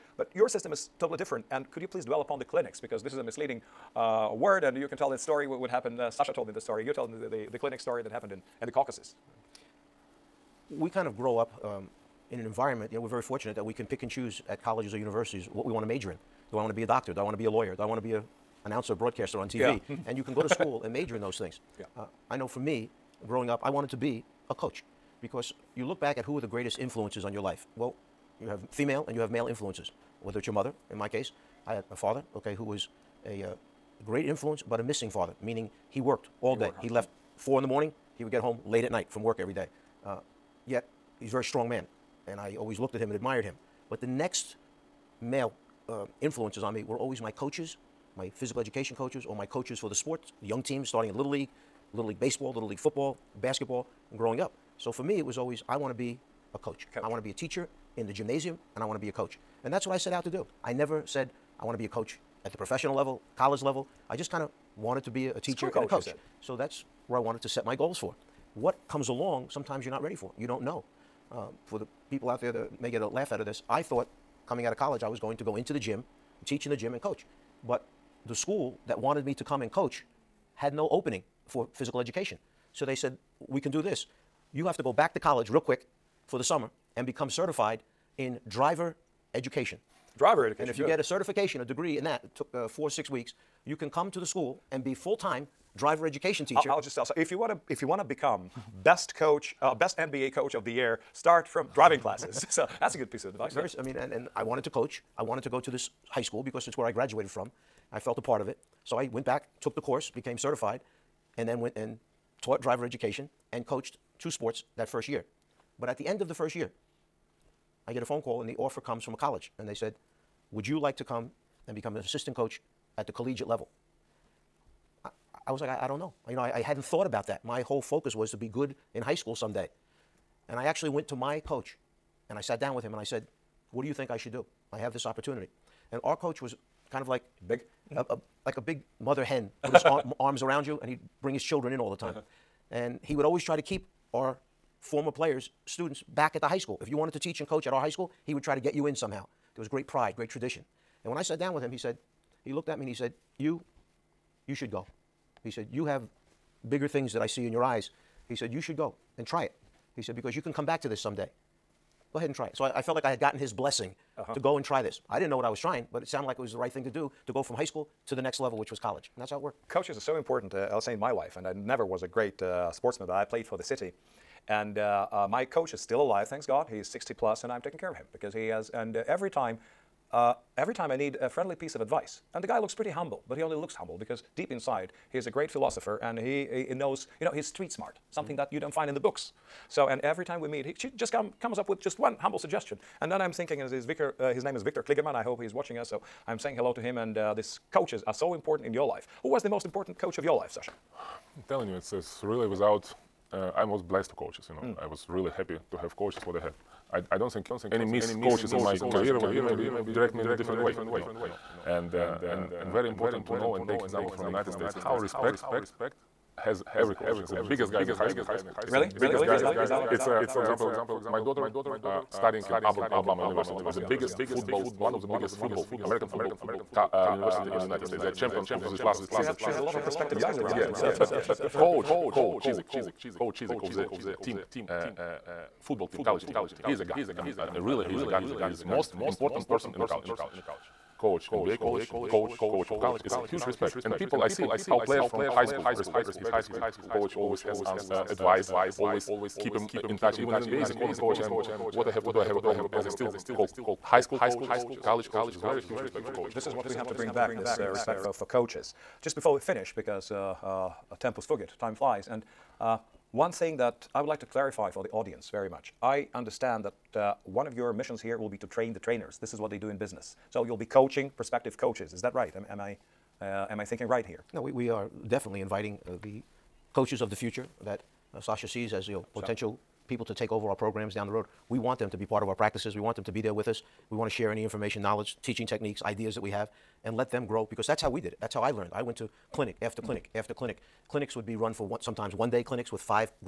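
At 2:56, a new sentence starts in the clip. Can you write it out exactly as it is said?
He's 60 plus, and I'm taking care of him because he has.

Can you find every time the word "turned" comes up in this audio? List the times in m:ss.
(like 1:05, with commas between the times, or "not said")
not said.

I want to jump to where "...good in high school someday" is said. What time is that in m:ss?
2:08.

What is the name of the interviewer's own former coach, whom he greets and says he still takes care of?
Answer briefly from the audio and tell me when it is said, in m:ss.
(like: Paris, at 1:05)
Victor Kligerman, at 3:14.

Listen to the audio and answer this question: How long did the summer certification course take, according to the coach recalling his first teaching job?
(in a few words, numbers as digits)
4 or 6 weeks.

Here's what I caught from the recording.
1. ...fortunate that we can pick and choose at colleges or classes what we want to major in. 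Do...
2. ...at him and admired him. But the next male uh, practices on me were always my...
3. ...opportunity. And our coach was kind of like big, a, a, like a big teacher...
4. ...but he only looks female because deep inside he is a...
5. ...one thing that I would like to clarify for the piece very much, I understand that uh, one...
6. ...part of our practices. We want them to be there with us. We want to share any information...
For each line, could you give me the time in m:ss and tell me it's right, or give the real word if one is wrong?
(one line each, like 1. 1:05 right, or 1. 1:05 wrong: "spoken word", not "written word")
1. 0:13 wrong: "universities", not "classes"
2. 0:42 wrong: "influences", not "practices"
3. 2:15 wrong: "mother", not "teacher"
4. 3:03 wrong: "humble", not "female"
5. 4:23 wrong: "audience", not "piece"
6. 4:42 right.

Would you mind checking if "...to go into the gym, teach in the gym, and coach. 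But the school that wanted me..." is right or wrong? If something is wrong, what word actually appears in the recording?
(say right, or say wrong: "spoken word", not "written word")
right.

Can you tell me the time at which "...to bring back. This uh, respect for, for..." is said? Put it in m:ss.
4:16.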